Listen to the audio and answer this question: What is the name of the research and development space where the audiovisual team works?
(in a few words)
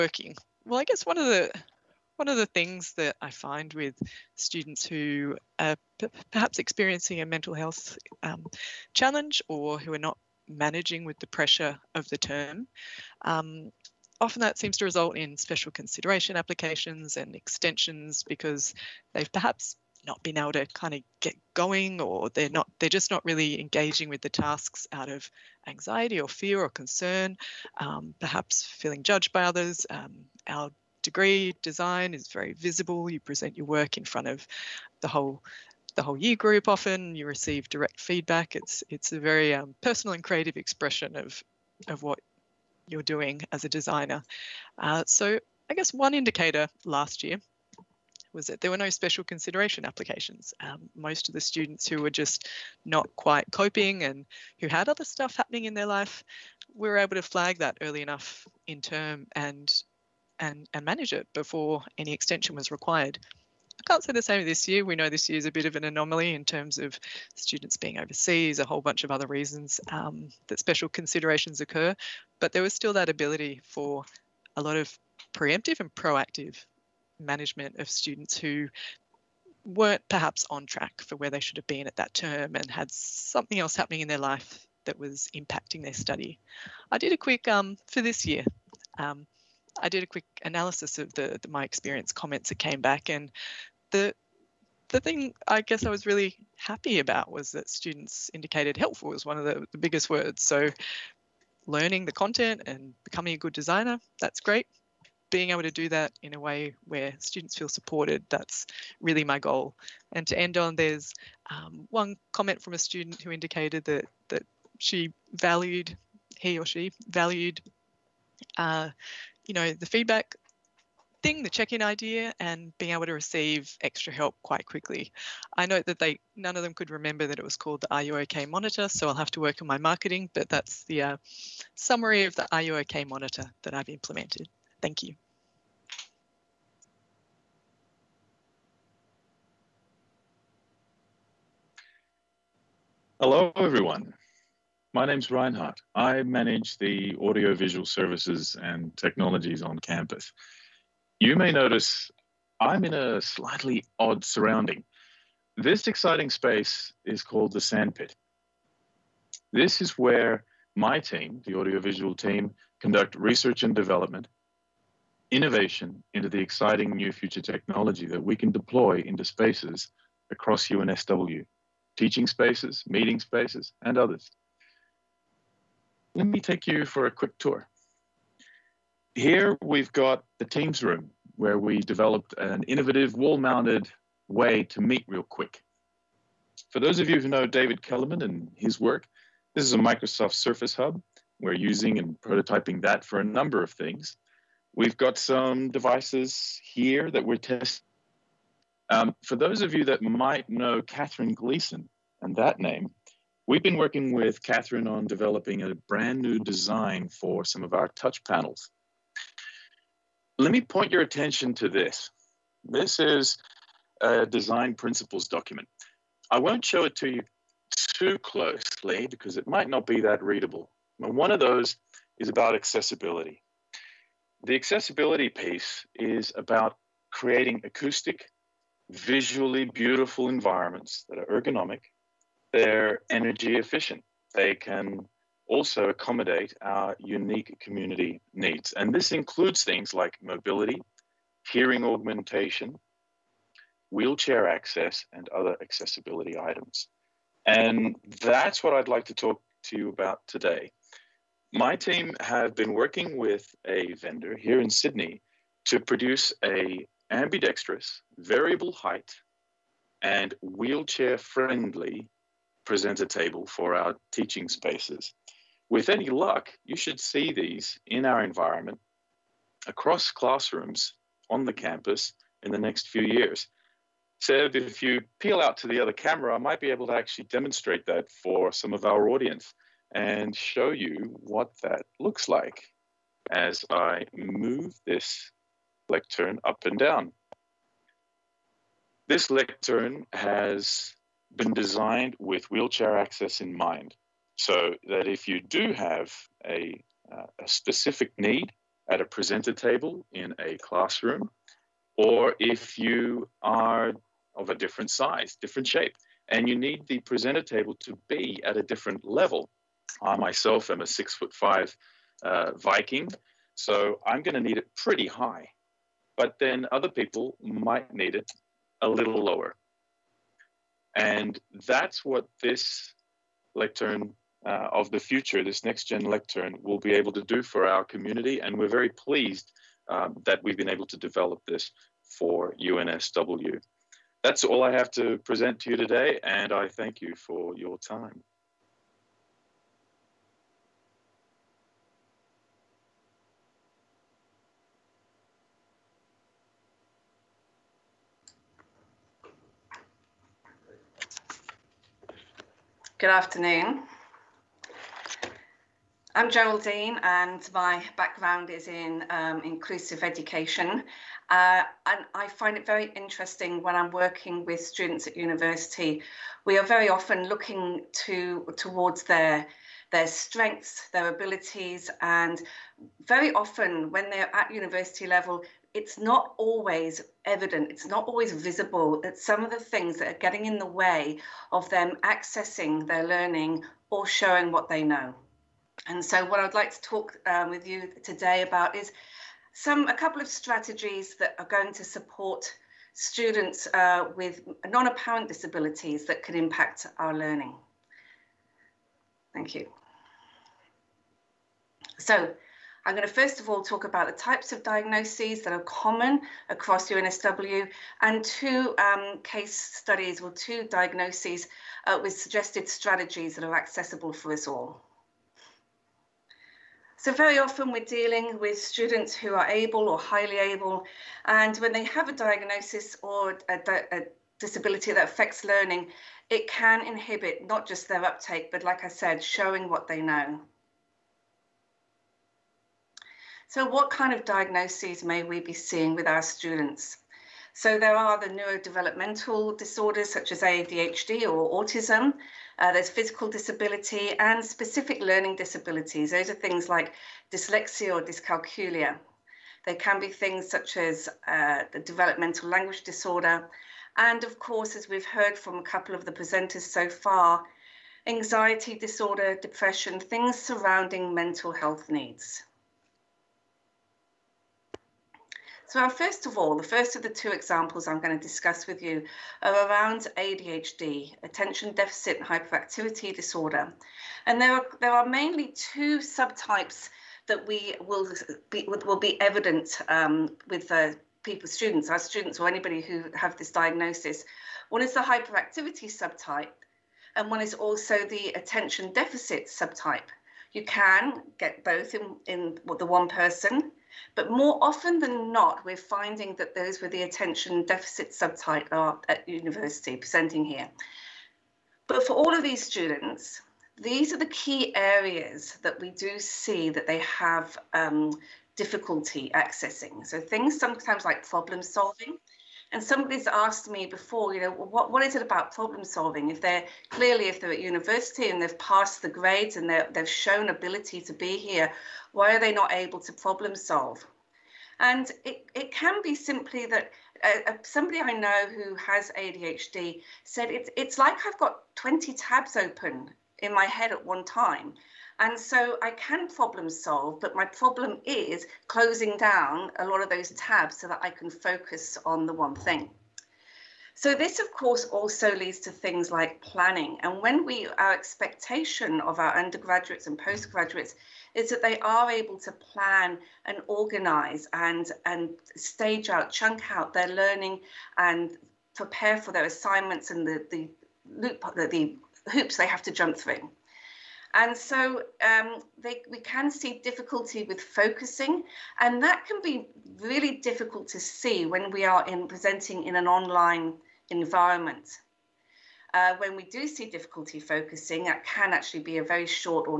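the sandpit.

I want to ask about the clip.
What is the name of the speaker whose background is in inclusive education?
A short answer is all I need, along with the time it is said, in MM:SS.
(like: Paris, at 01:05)
Geraldine, at 05:56.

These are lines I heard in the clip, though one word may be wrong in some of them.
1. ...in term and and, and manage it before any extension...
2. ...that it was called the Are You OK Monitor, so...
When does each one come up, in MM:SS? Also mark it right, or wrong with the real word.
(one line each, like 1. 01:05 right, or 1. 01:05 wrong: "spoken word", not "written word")
1. 00:58 right
2. 02:07 right.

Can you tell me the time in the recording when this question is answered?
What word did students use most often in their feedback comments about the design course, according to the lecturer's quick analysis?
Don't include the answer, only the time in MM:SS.
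01:38.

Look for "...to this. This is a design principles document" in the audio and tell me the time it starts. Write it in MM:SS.
03:31.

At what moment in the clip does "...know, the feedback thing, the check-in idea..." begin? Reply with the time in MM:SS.
01:59.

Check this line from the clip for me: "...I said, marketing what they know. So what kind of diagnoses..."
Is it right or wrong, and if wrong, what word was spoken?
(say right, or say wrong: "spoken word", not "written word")
wrong: "showing", not "marketing".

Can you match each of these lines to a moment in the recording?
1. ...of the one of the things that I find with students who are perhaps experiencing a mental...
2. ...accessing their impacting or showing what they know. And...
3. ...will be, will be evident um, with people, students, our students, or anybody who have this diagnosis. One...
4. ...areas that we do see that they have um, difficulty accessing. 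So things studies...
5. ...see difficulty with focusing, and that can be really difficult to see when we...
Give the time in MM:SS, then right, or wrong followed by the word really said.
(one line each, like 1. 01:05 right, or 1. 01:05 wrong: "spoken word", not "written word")
1. 00:01 right
2. 06:22 wrong: "learning", not "impacting"
3. 07:57 right
4. 08:24 wrong: "sometimes", not "studies"
5. 09:26 right.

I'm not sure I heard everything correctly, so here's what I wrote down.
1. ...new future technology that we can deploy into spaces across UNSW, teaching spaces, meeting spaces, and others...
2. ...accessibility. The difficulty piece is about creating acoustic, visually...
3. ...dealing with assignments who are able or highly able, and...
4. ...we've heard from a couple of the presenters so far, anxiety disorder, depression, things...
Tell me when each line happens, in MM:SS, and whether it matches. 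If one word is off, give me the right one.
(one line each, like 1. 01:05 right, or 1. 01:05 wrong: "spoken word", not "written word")
1. 02:46 right
2. 03:42 wrong: "accessibility", not "difficulty"
3. 06:57 wrong: "students", not "assignments"
4. 07:34 right.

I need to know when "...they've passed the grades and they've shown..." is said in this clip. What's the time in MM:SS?
08:38.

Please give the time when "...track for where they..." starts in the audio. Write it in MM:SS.
01:20.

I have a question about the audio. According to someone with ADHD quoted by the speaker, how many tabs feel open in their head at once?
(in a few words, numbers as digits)
20.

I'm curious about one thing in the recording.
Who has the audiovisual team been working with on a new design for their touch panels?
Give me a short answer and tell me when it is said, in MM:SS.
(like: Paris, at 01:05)
Catherine Gleason, at 03:20.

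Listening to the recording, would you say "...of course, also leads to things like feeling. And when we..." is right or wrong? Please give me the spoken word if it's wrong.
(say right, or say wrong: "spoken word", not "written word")
wrong: "planning", not "feeling".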